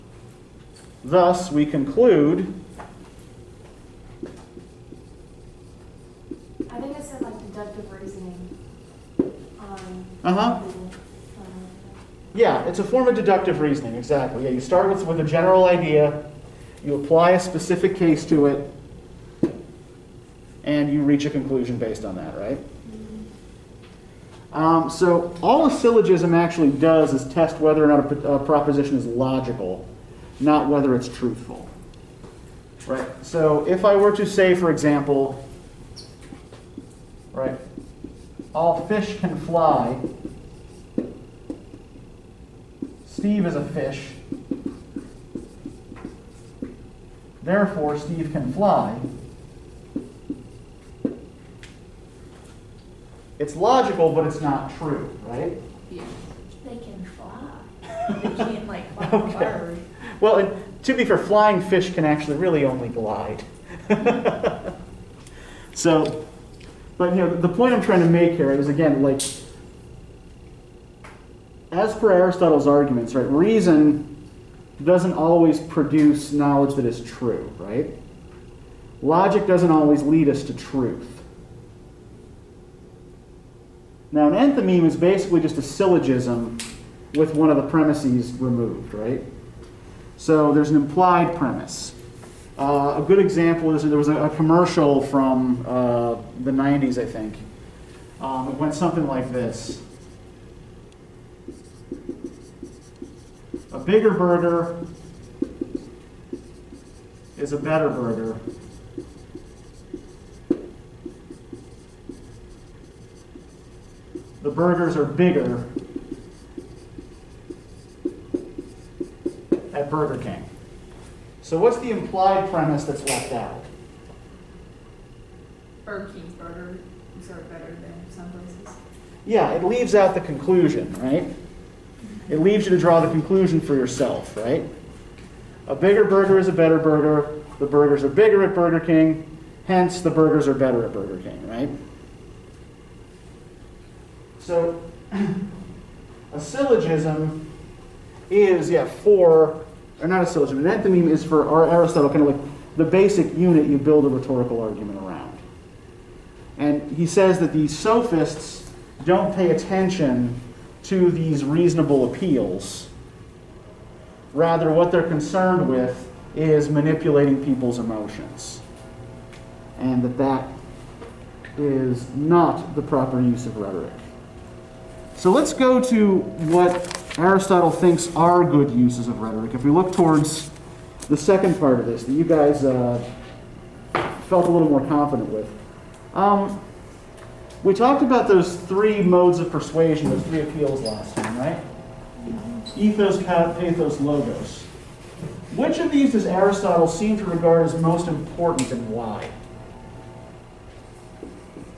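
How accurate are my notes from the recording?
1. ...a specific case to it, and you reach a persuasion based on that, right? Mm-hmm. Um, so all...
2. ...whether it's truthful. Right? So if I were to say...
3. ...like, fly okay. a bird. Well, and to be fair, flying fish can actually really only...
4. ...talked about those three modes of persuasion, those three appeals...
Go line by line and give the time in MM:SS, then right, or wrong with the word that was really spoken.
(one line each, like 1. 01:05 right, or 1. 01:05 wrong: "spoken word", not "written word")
1. 00:17 wrong: "conclusion", not "persuasion"
2. 00:30 right
3. 00:58 right
4. 03:07 right.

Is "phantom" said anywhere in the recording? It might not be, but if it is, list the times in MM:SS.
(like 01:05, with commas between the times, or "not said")
not said.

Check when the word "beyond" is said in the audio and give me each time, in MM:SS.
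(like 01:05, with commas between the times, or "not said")
not said.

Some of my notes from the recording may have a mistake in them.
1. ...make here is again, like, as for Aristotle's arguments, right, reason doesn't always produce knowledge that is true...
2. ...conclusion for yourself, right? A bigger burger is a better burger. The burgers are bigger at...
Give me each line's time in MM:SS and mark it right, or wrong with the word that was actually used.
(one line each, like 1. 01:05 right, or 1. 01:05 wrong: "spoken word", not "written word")
1. 01:08 right
2. 02:13 right.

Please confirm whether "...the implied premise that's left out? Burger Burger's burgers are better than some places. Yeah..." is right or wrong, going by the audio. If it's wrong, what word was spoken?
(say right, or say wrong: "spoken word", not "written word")
wrong: "King", not "Burger".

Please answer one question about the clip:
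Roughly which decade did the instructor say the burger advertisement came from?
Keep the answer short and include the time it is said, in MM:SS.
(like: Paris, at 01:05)
the 90s, at 01:36.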